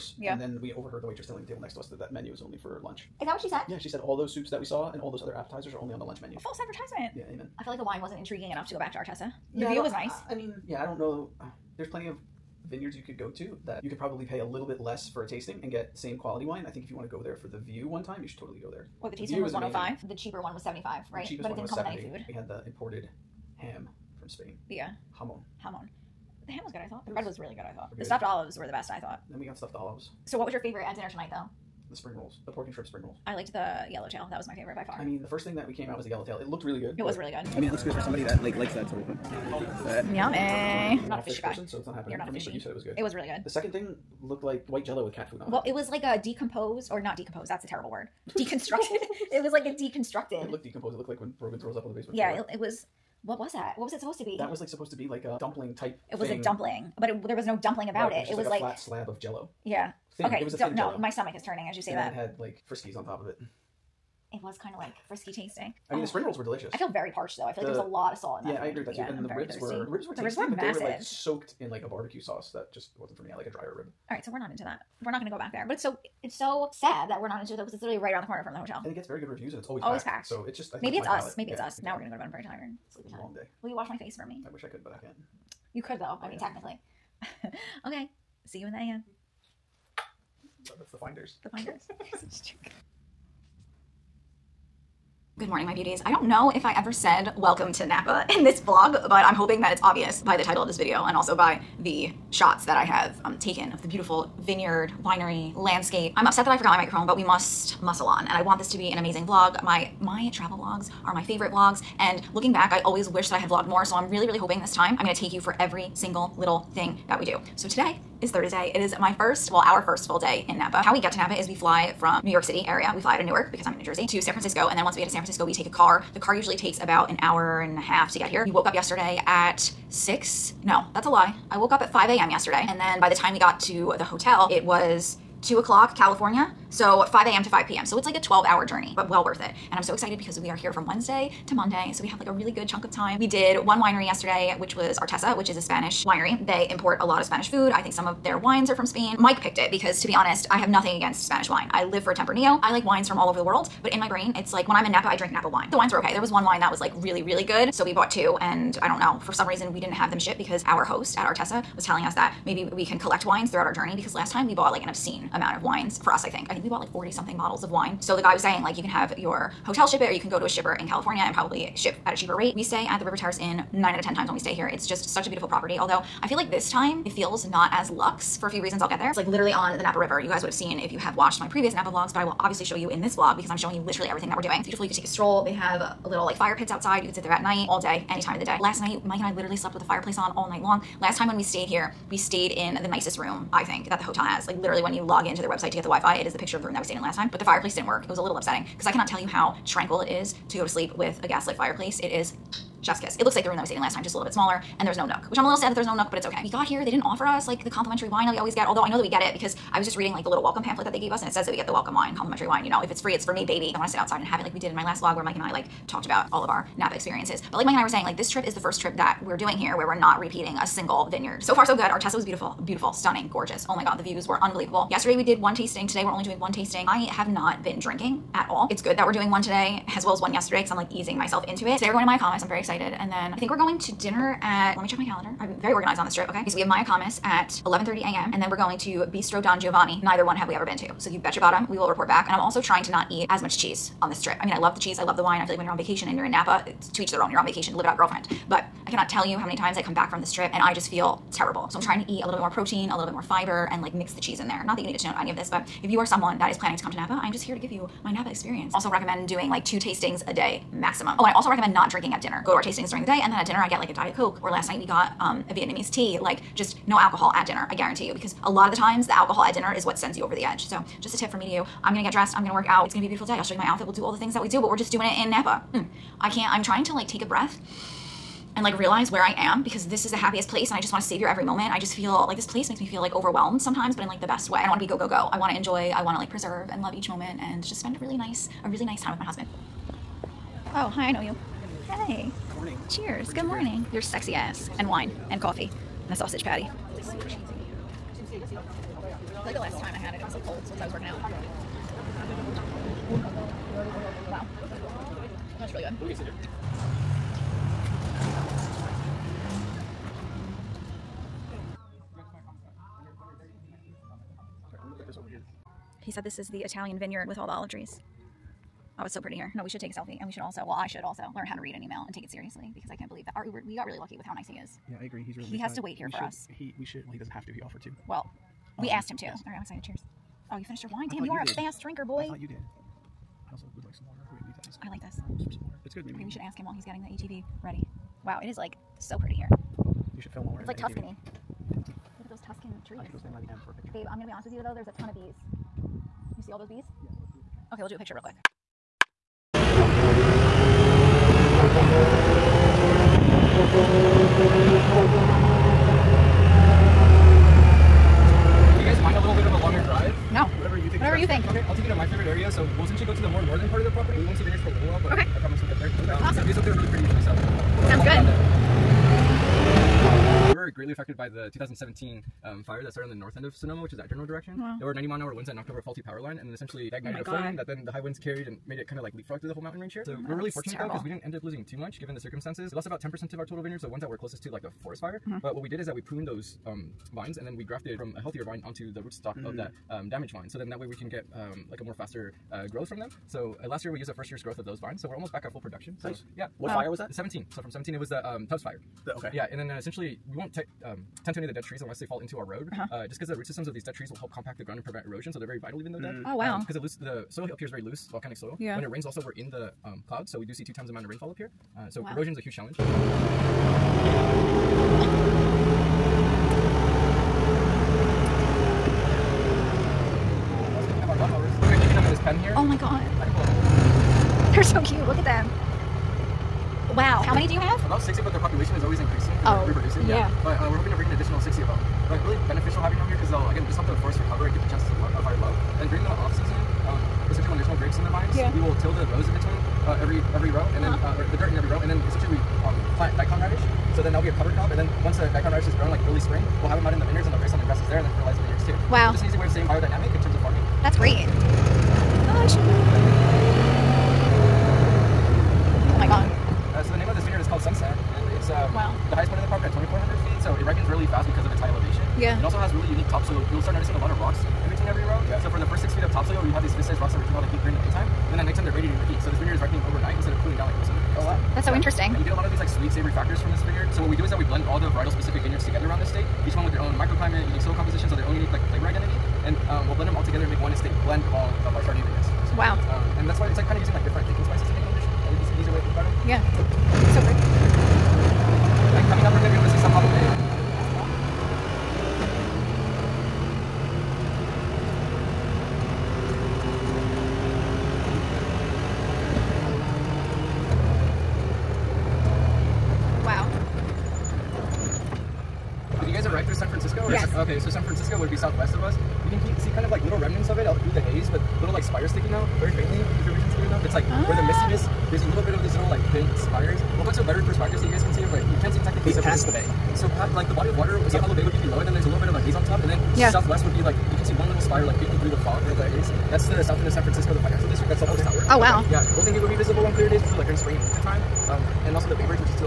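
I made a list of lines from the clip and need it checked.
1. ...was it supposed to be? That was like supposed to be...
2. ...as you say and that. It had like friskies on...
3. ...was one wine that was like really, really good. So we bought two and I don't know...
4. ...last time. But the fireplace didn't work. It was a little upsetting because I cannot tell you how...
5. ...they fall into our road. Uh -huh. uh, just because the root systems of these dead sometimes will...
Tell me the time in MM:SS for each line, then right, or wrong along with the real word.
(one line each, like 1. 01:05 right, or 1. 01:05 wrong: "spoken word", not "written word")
1. 00:53 right
2. 01:01 right
3. 02:36 right
4. 03:17 right
5. 06:41 wrong: "trees", not "sometimes".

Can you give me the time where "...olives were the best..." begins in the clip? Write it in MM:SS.
00:28.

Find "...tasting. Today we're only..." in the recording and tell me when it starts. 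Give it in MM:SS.
03:45.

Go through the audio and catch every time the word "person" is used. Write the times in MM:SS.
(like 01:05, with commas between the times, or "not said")
00:41.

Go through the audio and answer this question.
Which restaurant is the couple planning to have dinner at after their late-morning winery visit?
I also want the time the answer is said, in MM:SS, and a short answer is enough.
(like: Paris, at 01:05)
Bistro Don Giovanni, at 03:59.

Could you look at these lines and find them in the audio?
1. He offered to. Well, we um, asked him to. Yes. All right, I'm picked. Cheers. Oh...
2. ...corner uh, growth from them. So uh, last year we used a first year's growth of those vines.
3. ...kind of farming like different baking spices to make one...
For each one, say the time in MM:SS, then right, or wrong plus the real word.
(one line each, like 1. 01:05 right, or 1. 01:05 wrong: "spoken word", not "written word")
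1. 05:27 wrong: "excited", not "picked"
2. 06:32 wrong: "faster", not "corner"
3. 08:03 wrong: "using", not "farming".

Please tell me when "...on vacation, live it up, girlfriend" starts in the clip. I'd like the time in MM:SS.
04:07.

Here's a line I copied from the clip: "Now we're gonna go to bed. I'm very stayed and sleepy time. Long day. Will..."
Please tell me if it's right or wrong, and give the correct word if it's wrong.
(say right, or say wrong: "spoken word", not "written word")
wrong: "tired", not "stayed".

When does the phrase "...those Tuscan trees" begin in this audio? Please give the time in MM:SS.
05:42.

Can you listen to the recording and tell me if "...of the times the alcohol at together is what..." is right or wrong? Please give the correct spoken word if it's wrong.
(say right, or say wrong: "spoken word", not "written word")
wrong: "dinner", not "together".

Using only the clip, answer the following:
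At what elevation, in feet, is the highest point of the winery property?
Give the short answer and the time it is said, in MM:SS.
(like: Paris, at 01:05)
2,400 feet, at 07:39.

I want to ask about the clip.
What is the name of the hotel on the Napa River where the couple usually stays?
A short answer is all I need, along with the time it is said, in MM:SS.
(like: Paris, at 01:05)
River Terrace Inn, at 02:53.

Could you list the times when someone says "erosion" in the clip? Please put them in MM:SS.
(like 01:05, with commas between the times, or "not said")
06:45, 06:52.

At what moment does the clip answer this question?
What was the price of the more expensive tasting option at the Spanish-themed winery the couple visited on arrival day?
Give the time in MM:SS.
00:19.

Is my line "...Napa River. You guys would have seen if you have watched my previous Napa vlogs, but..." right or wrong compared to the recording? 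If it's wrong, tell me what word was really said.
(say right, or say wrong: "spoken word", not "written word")
right.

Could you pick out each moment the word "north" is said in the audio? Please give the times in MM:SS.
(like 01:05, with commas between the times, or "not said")
06:13.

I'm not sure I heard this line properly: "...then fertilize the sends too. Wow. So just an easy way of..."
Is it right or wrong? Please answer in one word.
wrong.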